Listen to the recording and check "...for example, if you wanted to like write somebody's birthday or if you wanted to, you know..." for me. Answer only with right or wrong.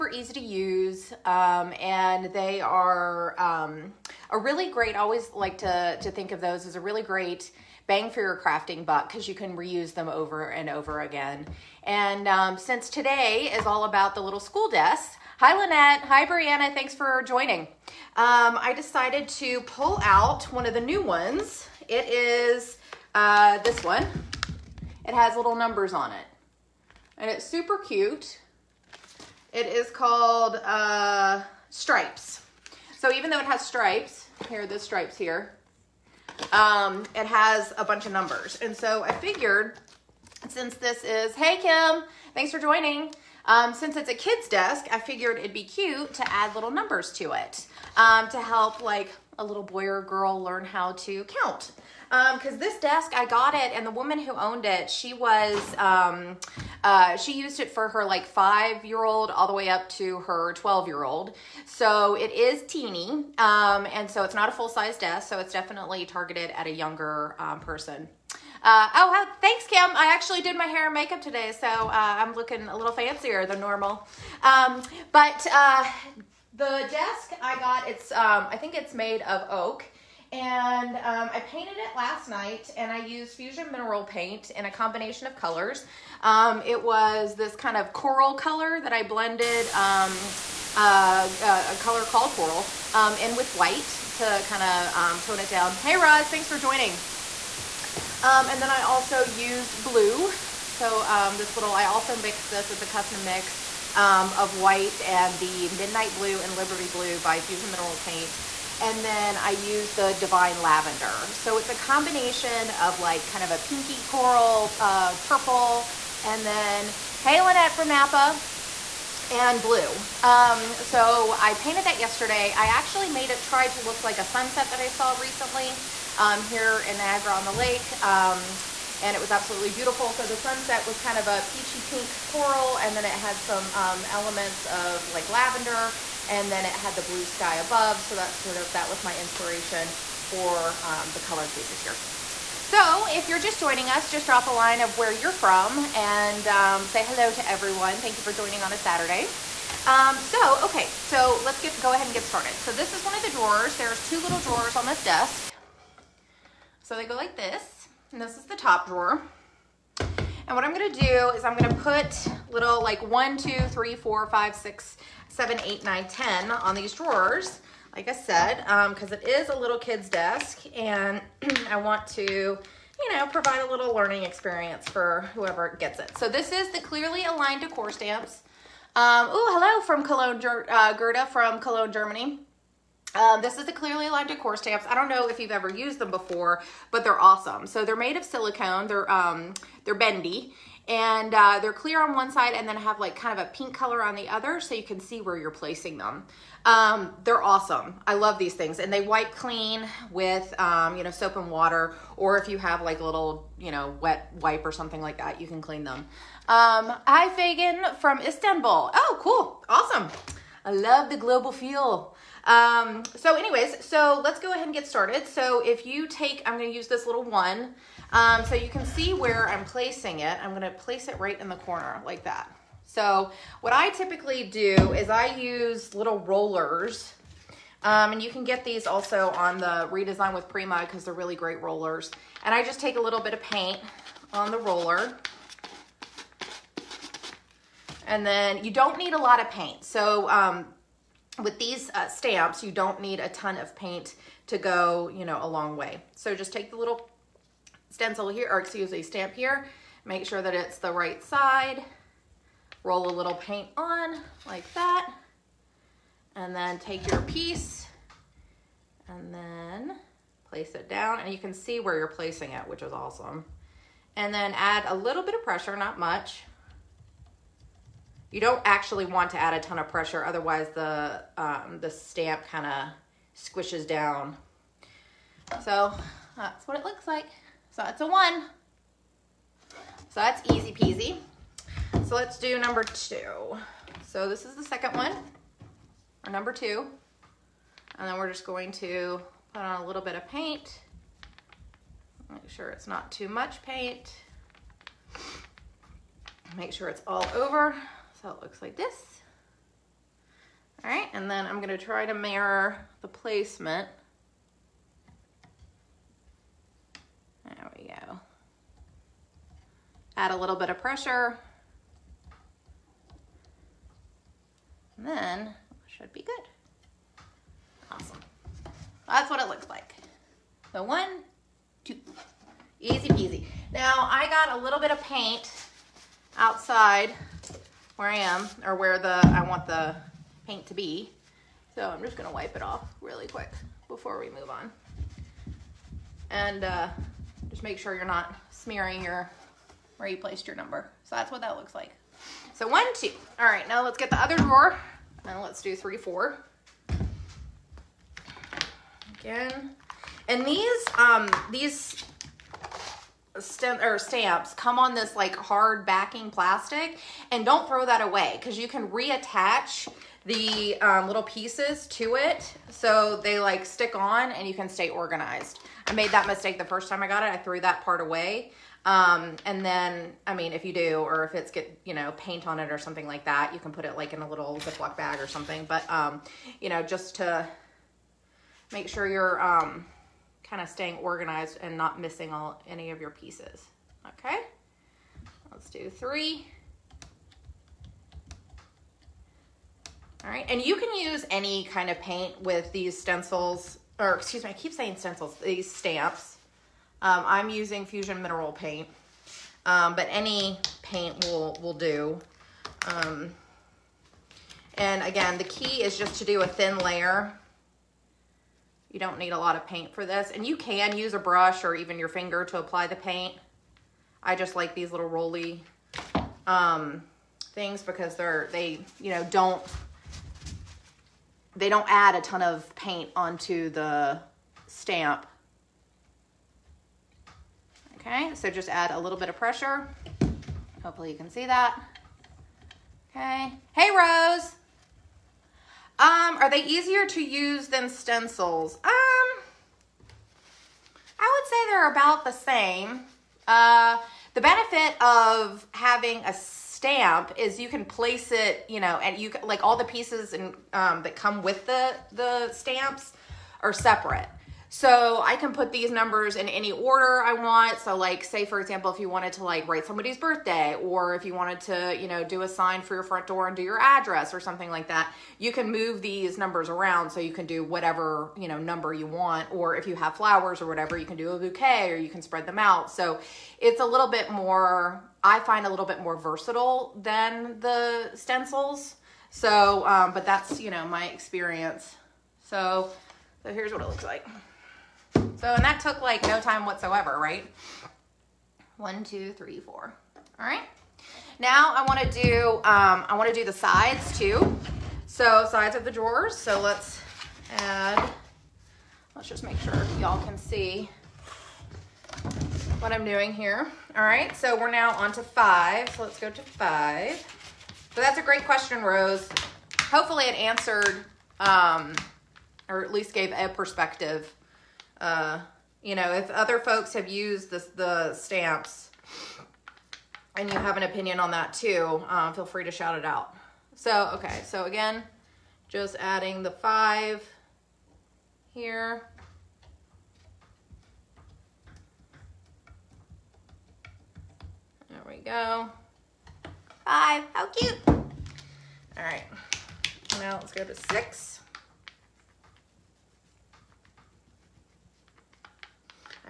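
right.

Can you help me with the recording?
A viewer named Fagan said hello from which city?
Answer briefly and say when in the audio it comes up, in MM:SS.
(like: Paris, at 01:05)
Istanbul, at 03:28.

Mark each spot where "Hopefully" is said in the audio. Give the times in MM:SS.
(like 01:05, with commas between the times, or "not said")
07:10, 08:29.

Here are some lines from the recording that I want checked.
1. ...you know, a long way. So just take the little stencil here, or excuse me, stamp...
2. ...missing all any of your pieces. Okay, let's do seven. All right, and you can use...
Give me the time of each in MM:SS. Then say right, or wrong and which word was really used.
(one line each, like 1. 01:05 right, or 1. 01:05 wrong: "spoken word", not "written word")
1. 04:05 right
2. 06:22 wrong: "three", not "seven".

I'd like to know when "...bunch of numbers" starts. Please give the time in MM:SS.
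00:37.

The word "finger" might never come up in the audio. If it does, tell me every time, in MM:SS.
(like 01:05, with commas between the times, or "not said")
06:52.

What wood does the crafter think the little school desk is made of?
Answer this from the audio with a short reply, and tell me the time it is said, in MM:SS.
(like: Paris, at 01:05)
Oak, at 01:19.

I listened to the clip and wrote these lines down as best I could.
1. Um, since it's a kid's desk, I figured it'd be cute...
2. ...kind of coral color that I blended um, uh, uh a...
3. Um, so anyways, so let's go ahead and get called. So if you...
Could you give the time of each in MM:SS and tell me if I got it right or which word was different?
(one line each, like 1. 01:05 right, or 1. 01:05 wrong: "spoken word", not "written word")
1. 00:43 right
2. 01:27 right
3. 03:32 wrong: "started", not "called".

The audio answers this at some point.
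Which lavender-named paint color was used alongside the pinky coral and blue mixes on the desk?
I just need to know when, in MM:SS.
01:50.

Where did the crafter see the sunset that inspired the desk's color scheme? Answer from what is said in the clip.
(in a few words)
Niagara on the Lake.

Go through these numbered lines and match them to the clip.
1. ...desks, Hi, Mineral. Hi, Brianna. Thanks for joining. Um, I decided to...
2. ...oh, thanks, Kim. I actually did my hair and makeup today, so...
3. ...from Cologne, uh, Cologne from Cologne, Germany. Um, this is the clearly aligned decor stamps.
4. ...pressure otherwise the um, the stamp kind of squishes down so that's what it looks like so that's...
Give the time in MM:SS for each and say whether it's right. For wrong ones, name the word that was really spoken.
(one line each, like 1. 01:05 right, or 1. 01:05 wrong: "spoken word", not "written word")
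1. 00:14 wrong: "Lynette", not "Mineral"
2. 01:08 right
3. 02:59 wrong: "Gerda", not "Cologne"
4. 04:29 right.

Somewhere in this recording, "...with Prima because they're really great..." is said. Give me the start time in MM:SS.
03:50.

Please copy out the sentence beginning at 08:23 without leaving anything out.
All right, so we're now on to five.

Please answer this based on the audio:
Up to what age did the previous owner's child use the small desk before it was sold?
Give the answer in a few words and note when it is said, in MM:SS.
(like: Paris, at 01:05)
12, at 01:00.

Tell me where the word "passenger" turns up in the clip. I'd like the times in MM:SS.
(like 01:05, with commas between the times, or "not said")
not said.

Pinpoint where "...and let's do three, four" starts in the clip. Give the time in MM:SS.
05:45.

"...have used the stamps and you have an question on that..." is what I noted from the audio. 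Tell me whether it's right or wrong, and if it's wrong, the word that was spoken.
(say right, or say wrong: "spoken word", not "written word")
wrong: "opinion", not "question".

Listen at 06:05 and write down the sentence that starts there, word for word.
I made that mistake the first time I got it.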